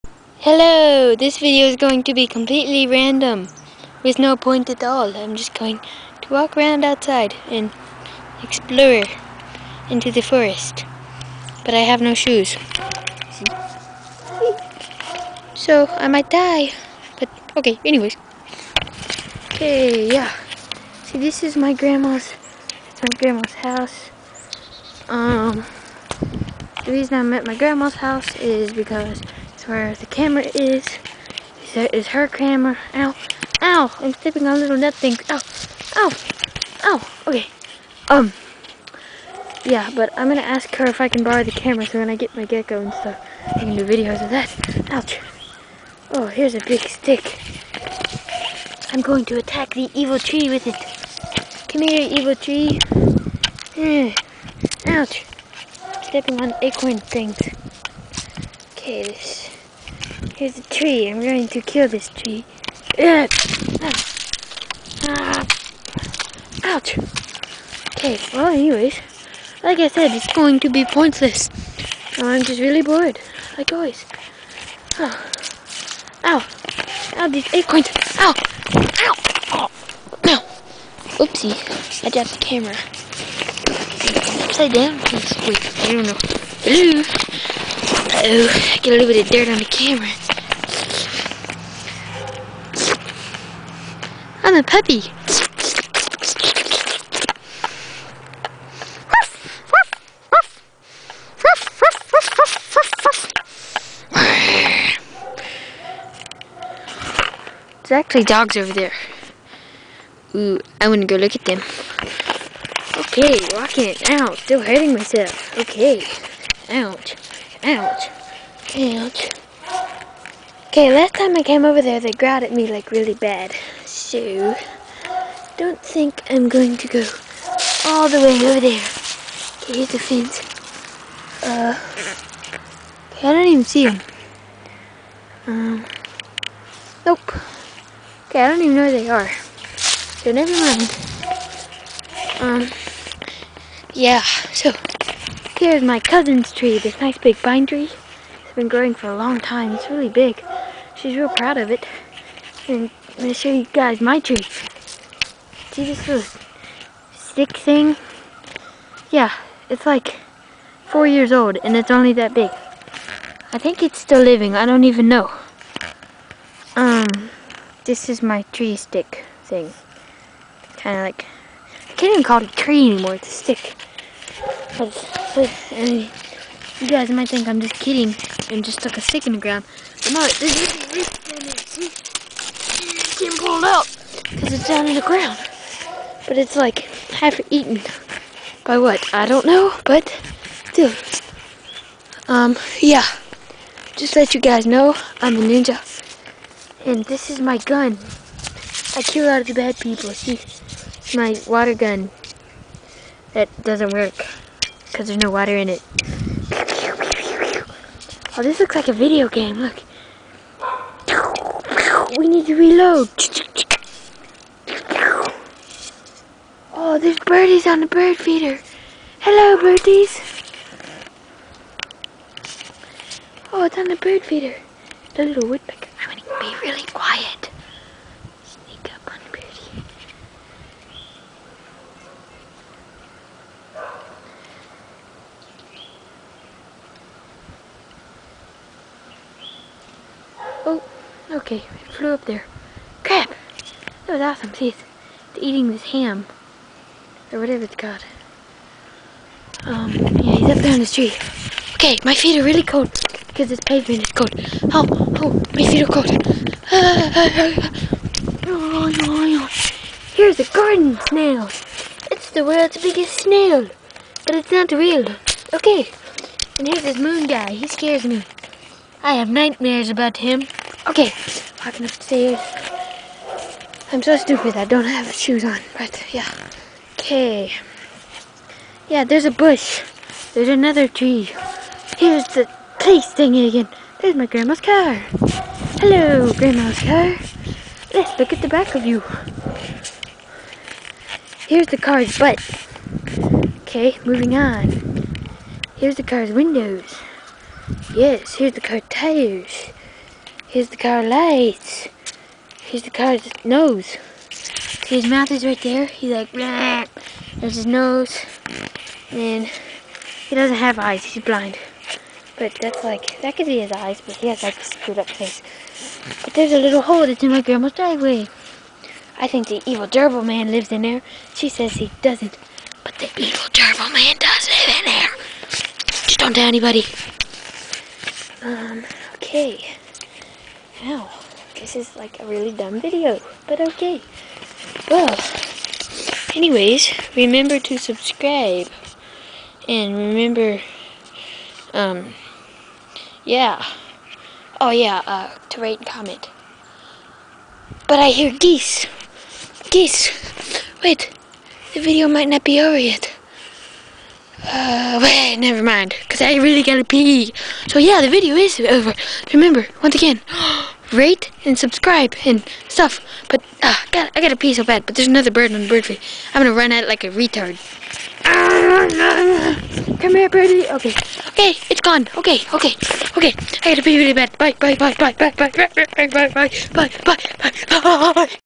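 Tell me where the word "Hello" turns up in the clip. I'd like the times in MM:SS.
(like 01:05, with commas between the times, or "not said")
00:00, 01:26, 03:39, 04:45.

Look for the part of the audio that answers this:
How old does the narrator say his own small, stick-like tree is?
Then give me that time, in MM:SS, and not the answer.
02:40.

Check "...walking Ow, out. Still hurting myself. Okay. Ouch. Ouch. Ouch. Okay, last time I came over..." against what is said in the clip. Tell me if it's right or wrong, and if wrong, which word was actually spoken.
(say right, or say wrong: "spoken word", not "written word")
right.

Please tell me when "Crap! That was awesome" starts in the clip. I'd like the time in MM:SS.
04:03.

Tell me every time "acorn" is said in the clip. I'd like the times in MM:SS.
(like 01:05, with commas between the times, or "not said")
00:56, 01:17.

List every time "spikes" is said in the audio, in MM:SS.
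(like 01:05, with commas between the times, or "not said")
not said.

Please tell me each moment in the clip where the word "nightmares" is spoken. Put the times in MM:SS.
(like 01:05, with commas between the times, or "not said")
04:29.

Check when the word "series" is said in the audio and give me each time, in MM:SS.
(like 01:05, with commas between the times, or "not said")
not said.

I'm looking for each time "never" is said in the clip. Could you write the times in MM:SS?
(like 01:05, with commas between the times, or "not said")
02:20, 05:55.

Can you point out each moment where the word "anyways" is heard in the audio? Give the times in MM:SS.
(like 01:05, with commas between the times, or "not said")
00:17, 01:08, 05:36.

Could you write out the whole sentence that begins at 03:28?
Oh, this looks like a video game.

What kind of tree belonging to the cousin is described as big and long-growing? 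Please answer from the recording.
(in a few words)
Pine tree.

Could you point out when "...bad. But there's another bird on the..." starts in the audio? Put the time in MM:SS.
06:04.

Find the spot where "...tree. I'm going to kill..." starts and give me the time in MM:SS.
01:00.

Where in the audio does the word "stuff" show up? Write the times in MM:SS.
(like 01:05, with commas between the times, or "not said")
00:42, 06:02.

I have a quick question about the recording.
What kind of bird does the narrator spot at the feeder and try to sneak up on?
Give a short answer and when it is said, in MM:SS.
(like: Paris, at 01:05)
Woodpecker, at 03:45.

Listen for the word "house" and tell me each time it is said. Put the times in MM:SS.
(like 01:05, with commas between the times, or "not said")
00:23, 00:28.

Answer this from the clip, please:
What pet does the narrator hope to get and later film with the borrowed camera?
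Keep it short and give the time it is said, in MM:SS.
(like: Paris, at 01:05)
Gecko, at 00:42.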